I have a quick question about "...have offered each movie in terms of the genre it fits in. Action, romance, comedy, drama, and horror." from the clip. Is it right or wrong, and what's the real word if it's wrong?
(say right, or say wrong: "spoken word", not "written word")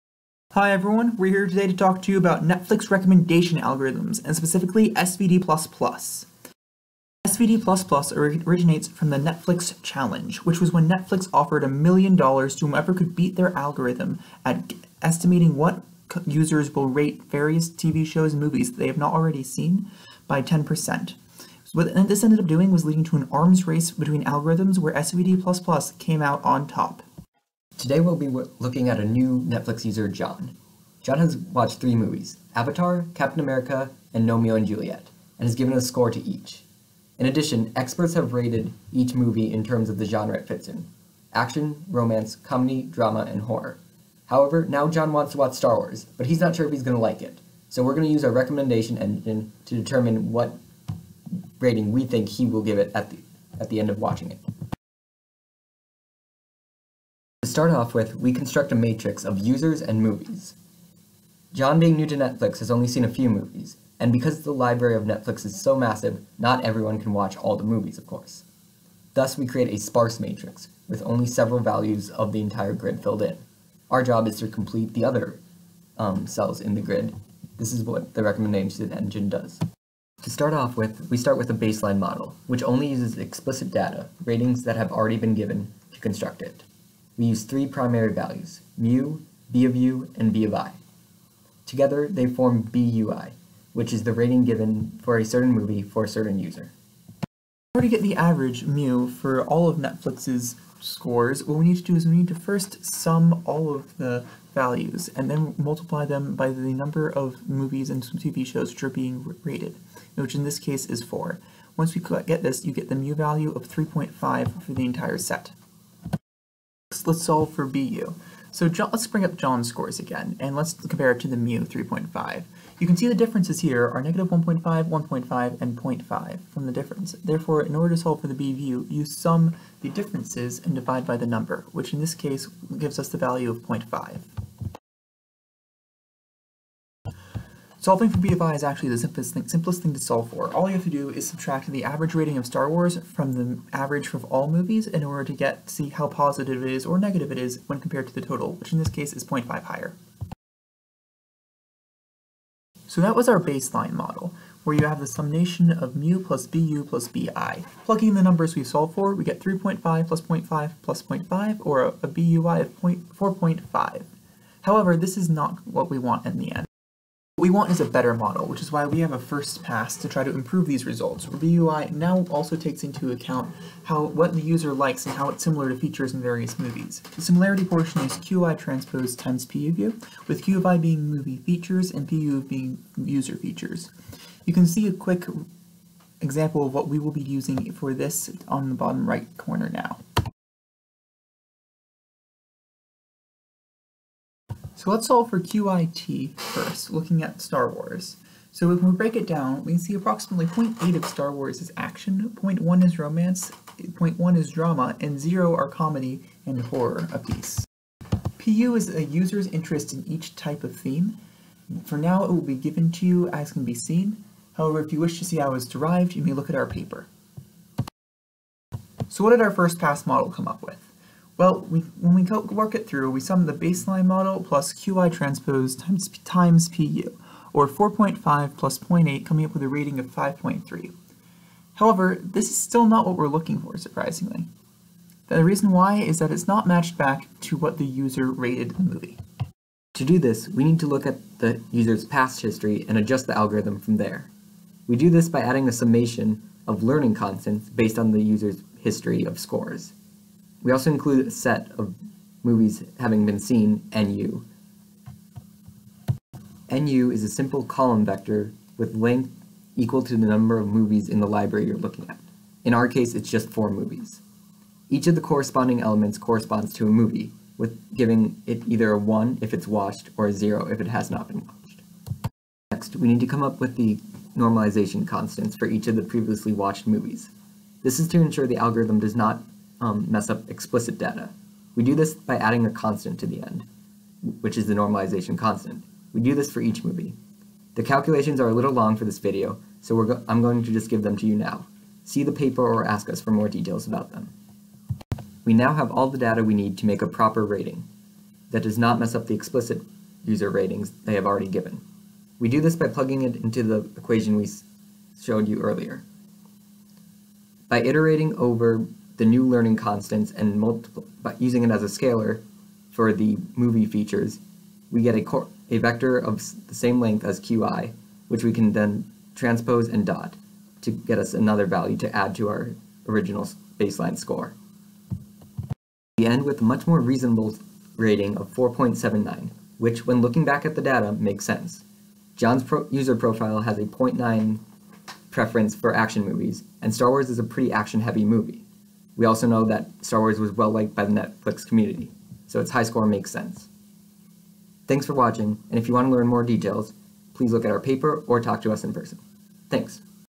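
wrong: "rated", not "offered".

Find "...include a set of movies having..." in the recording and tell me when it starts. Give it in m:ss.
4:10.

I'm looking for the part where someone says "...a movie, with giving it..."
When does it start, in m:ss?
4:26.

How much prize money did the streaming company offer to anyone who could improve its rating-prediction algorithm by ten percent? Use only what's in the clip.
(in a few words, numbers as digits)
a million dollars.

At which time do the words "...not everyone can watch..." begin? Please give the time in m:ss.
1:06.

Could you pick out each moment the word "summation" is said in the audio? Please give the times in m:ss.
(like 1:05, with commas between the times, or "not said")
2:35, 4:05.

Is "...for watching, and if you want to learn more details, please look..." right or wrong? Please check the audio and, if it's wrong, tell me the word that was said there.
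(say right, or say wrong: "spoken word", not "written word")
right.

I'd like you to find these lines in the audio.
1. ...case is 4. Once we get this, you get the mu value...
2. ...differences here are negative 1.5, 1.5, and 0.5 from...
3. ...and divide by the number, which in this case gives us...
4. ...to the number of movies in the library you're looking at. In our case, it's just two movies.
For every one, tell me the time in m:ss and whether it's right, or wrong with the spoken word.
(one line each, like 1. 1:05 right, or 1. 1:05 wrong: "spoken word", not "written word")
1. 1:50 right
2. 2:03 right
3. 2:10 right
4. 4:20 wrong: "four", not "two".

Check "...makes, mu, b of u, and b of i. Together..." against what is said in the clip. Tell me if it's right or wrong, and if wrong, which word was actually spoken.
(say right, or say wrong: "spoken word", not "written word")
wrong: "values", not "makes".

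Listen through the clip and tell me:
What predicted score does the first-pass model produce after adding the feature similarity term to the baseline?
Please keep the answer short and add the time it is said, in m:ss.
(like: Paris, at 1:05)
5.3, at 3:50.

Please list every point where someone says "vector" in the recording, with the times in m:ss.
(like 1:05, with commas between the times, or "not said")
4:18, 5:15.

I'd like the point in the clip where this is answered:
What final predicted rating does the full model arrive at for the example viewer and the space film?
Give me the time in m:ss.
5:28.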